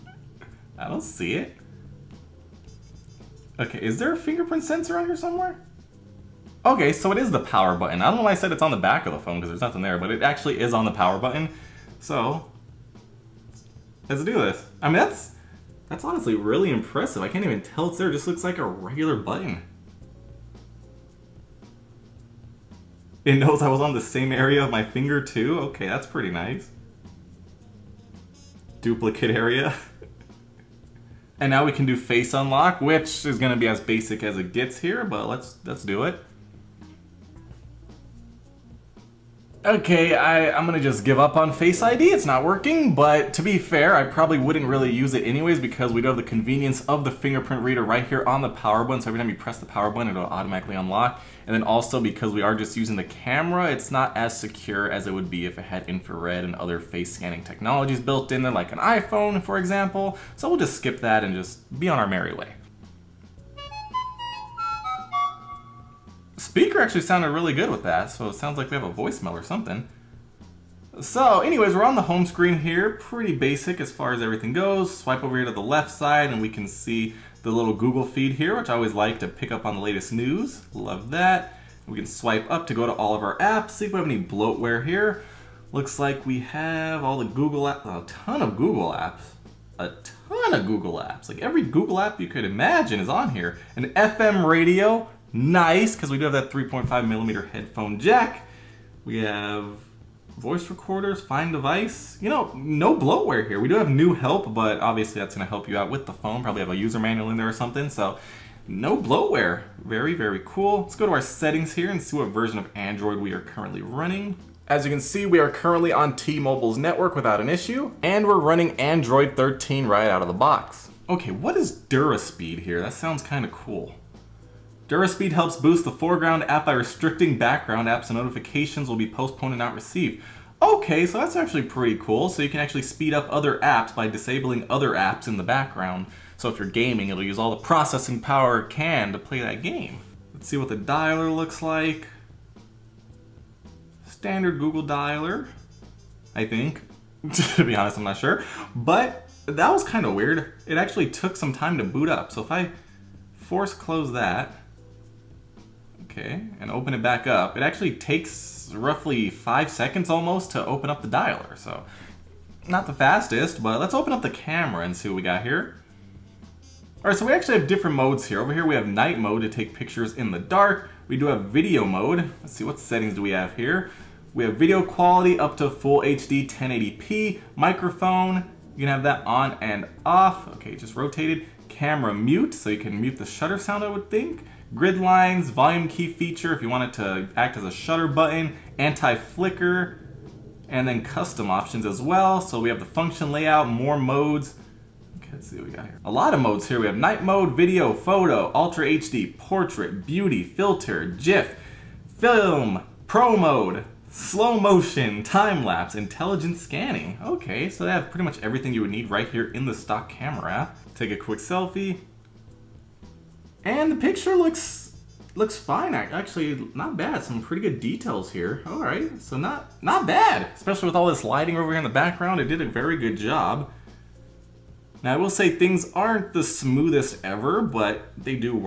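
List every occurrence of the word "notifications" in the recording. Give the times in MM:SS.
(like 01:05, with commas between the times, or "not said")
02:08.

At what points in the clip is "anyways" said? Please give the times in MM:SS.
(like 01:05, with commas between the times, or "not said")
00:45, 01:11.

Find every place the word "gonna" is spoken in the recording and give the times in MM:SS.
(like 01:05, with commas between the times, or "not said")
00:33, 00:40, 01:45.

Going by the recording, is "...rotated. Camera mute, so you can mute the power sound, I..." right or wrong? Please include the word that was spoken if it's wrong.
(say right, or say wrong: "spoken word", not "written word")
wrong: "shutter", not "power".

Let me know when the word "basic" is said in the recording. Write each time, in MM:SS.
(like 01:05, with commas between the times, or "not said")
00:33, 01:13.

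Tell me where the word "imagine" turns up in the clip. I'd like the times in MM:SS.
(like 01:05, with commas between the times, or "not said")
01:32.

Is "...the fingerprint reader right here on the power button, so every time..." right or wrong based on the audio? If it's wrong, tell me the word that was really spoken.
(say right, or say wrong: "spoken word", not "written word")
right.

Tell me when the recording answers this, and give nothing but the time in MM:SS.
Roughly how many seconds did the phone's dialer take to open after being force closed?
02:39.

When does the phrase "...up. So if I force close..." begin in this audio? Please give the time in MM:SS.
02:32.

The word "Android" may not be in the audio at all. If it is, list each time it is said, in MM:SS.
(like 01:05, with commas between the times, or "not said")
01:52, 01:58.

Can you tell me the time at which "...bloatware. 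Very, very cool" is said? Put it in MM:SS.
01:48.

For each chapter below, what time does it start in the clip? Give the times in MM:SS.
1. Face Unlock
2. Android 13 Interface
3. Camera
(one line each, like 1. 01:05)
1. 00:30
2. 01:02
3. 02:42.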